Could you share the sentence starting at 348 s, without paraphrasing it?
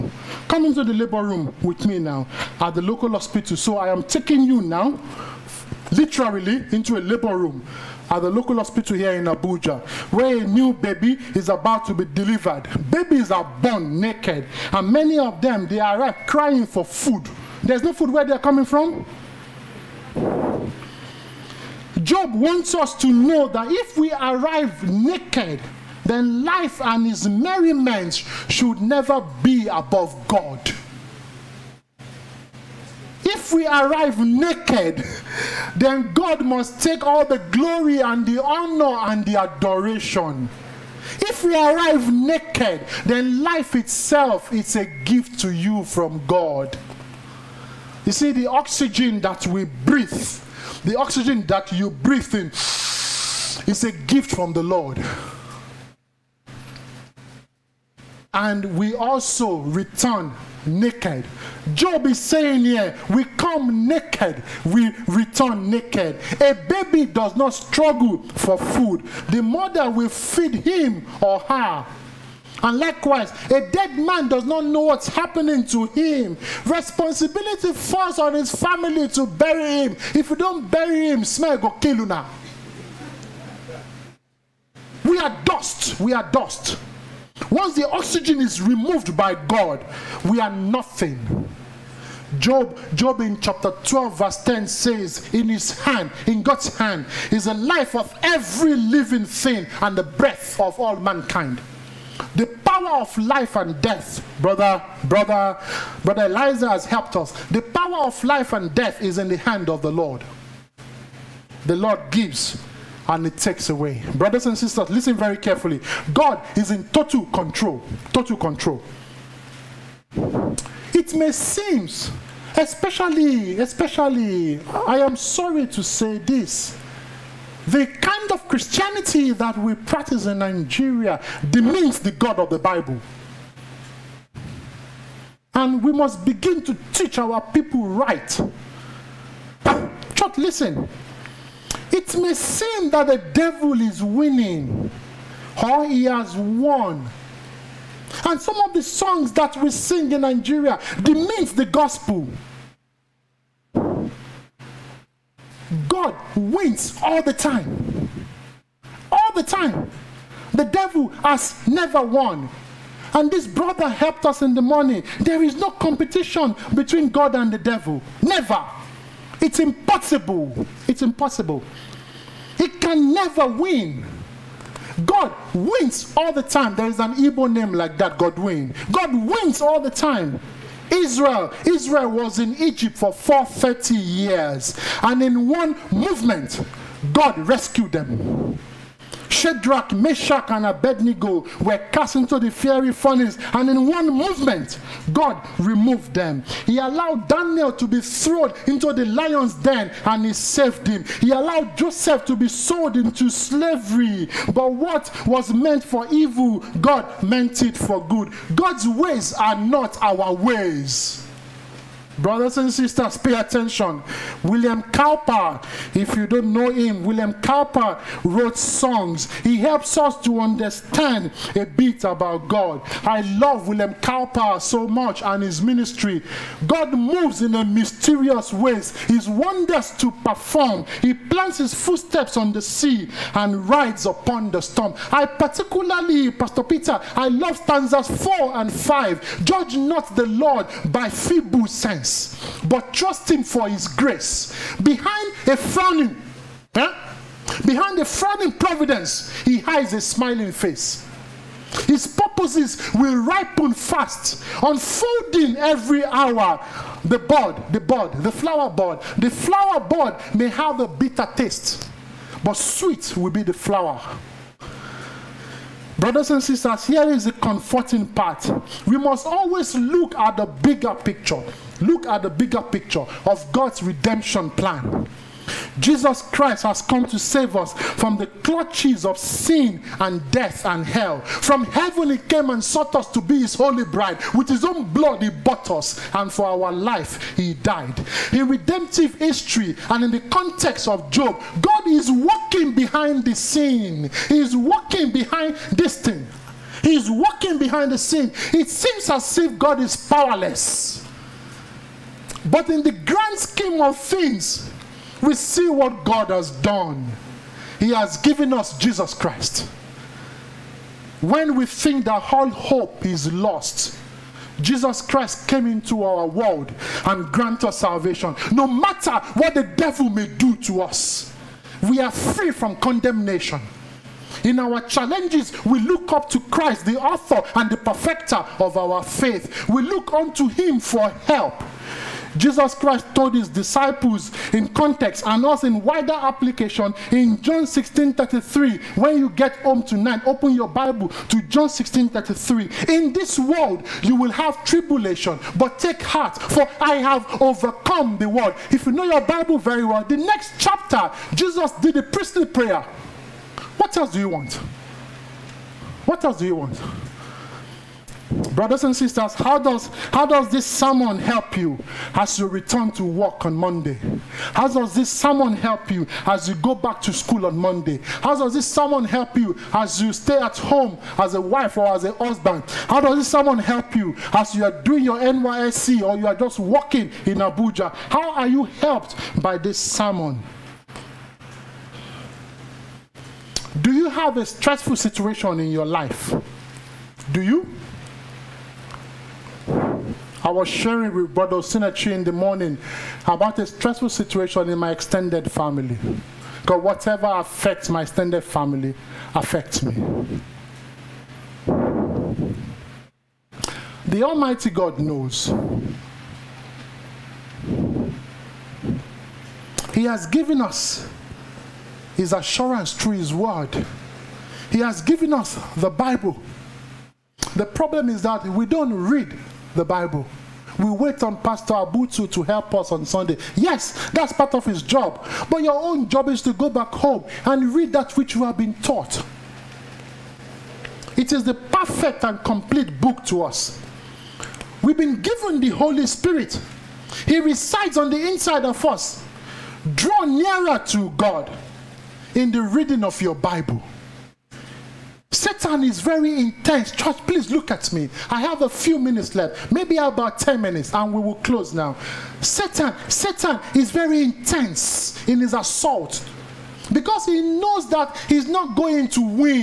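If you know your Bible very well, the next chapter, Jesus did a priestly prayer.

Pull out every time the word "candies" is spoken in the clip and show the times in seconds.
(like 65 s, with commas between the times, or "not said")
not said.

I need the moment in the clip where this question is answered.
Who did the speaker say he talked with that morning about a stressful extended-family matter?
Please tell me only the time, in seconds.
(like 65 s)
391 s.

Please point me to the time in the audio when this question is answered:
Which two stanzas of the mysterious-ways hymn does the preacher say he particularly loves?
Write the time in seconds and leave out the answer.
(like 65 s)
238 s.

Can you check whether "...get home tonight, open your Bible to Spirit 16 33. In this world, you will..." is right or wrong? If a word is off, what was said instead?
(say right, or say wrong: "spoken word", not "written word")
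wrong: "John", not "Spirit".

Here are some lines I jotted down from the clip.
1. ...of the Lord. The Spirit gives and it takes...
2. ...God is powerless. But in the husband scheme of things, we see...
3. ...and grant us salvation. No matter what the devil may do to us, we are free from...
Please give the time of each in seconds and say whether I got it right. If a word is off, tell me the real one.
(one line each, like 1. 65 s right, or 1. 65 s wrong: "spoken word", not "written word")
1. 109 s wrong: "Lord", not "Spirit"
2. 299 s wrong: "grand", not "husband"
3. 317 s right.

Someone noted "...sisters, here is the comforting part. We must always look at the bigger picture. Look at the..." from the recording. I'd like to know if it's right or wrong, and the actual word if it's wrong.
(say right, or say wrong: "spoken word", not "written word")
right.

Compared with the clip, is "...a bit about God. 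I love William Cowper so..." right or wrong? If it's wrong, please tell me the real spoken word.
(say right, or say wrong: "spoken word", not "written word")
right.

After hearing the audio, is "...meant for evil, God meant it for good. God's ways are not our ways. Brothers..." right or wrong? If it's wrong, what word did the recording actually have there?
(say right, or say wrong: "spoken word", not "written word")
right.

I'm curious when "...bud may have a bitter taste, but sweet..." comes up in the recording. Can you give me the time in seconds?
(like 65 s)
259 s.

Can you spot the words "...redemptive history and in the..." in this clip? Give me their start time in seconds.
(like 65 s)
288 s.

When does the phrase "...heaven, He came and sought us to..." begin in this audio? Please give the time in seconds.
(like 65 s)
281 s.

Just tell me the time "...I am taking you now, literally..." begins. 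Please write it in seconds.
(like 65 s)
3 s.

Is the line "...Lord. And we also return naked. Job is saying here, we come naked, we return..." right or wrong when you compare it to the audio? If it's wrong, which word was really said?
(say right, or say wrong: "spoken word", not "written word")
right.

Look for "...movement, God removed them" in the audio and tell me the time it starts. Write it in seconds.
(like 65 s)
194 s.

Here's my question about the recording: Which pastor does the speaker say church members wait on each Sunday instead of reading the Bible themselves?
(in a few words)
Pastor Abutu.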